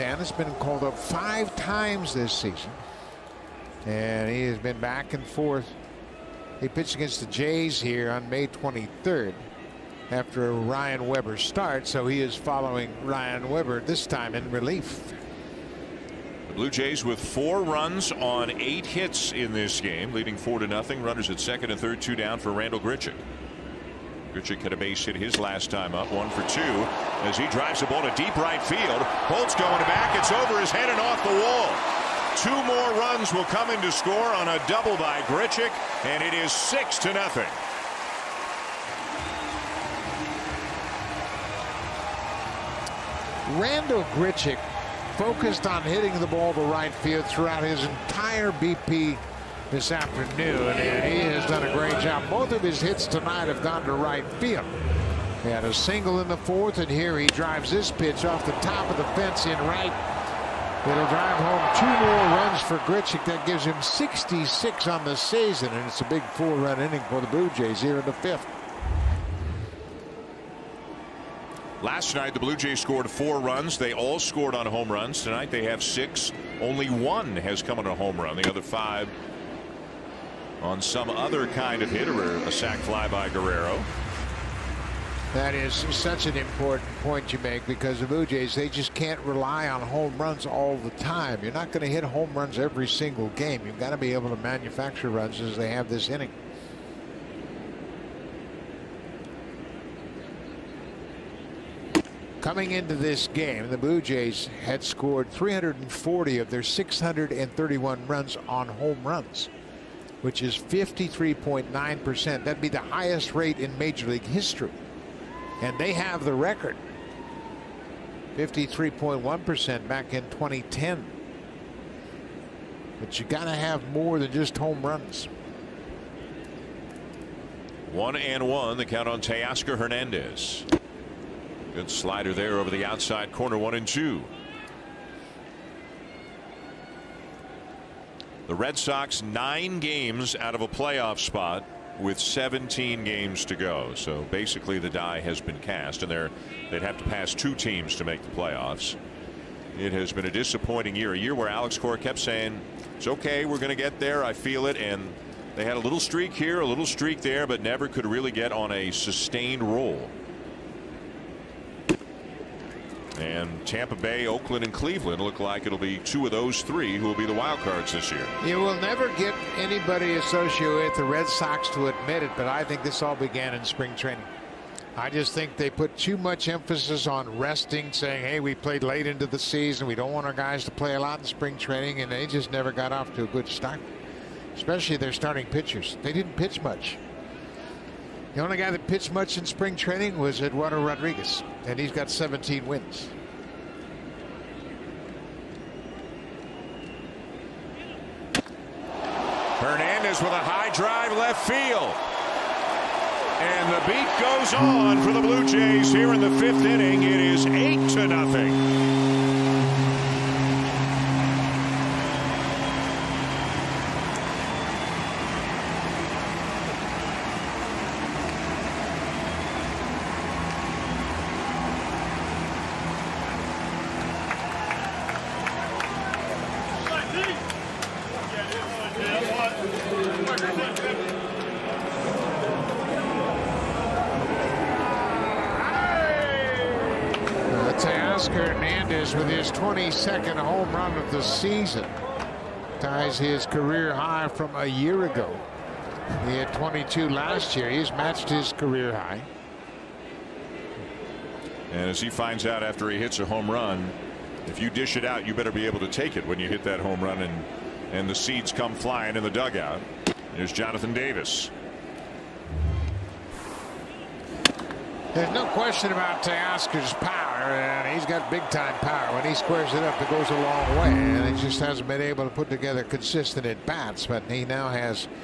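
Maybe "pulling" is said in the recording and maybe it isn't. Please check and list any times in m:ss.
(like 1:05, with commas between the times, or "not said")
not said.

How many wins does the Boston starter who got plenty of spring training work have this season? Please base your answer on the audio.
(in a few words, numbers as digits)
17.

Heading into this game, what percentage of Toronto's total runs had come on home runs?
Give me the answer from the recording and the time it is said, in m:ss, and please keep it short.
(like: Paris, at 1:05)
53.9%, at 1:50.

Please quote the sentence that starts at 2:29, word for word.
It has been a disappointing year a year where Alex Cora kept saying it's OK.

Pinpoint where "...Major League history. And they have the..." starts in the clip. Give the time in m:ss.
1:53.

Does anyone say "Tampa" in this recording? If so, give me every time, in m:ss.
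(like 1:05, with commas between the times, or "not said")
2:43.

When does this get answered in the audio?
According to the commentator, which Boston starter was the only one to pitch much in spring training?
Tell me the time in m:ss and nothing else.
3:10.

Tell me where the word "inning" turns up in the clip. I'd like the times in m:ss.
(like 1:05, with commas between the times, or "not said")
1:06, 1:36, 3:26.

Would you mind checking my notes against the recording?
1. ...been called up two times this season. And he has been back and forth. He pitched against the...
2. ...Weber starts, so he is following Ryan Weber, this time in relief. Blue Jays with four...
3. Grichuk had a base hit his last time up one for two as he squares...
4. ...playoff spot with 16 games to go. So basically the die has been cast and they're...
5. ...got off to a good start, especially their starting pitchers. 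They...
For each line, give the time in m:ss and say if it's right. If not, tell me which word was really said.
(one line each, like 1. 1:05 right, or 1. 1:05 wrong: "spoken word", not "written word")
1. 0:00 wrong: "five", not "two"
2. 0:11 right
3. 0:24 wrong: "drives", not "squares"
4. 2:20 wrong: "17", not "16"
5. 3:02 right.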